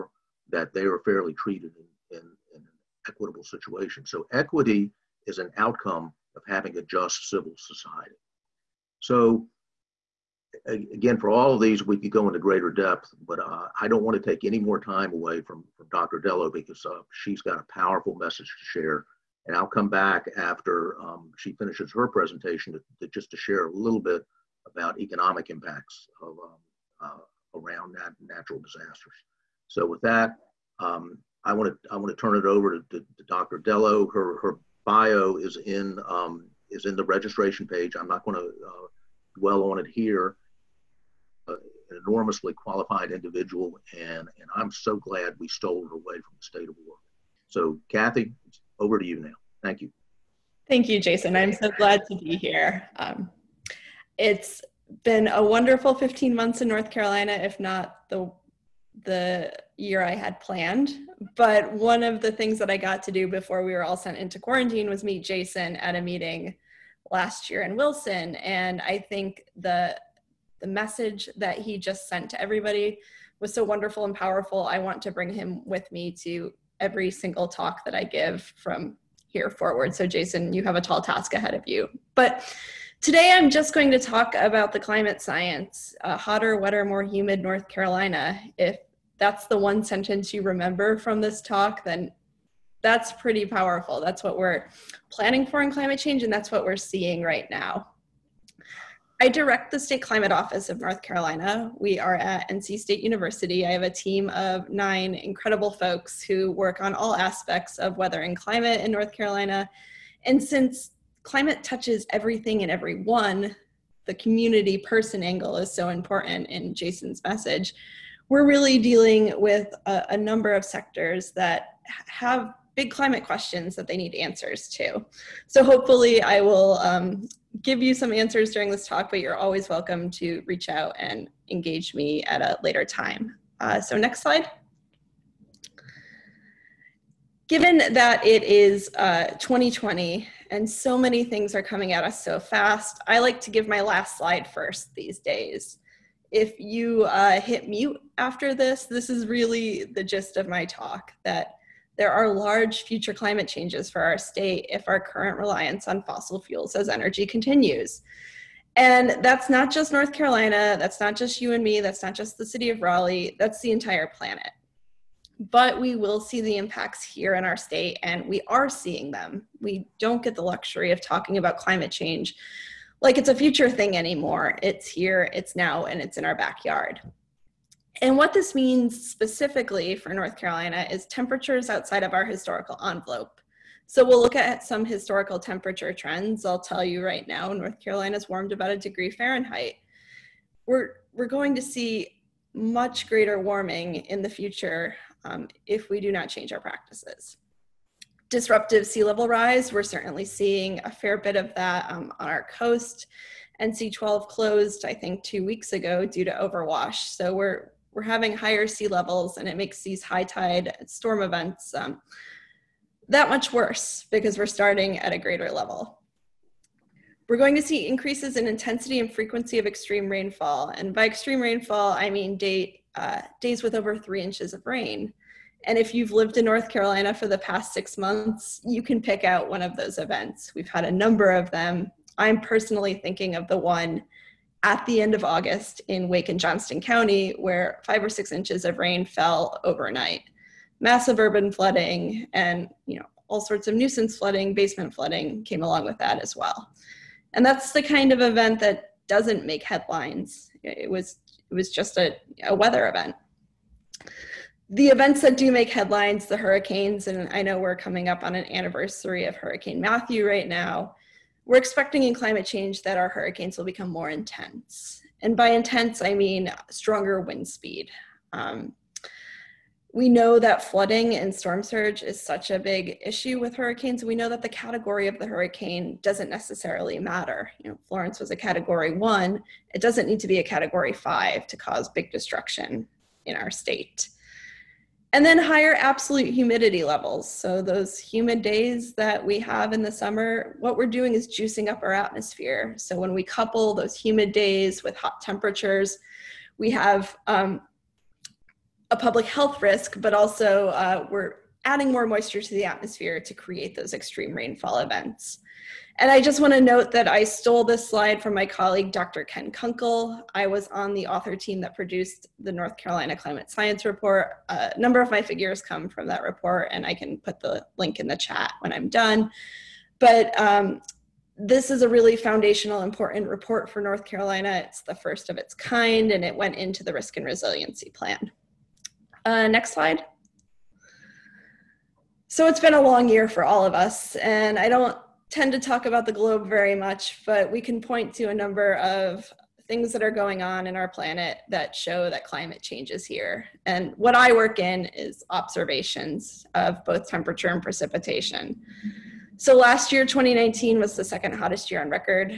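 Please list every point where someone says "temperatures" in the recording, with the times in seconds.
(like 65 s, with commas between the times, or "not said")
181 s, 185 s, 295 s, 347 s.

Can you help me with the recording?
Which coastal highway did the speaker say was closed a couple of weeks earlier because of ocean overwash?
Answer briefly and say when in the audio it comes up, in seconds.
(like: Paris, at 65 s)
NC12, at 203 s.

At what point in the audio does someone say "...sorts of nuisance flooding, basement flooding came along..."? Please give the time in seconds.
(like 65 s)
243 s.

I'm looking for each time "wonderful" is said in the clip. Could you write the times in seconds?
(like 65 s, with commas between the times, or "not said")
55 s, 73 s.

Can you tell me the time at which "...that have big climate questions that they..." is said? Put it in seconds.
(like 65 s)
121 s.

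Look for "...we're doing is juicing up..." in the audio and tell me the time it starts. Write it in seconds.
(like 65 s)
290 s.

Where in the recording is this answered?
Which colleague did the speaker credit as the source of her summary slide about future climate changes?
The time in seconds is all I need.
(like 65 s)
308 s.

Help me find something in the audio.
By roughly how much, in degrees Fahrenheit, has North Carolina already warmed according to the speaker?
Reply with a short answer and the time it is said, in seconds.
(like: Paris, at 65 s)
1 degree, at 188 s.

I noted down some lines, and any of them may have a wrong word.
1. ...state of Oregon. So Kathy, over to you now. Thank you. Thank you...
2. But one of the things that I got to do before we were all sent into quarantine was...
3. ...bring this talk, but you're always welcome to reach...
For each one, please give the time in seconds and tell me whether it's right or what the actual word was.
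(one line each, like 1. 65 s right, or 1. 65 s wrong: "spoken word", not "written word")
1. 46 s right
2. 61 s right
3. 128 s wrong: "during", not "bring".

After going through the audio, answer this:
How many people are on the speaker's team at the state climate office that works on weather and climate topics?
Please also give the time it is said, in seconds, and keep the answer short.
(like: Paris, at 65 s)
9, at 104 s.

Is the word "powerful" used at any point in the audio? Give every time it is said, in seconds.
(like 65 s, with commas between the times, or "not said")
17 s, 74 s, 93 s.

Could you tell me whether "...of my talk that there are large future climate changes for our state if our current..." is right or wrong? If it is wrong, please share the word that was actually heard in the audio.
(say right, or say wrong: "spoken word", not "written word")
right.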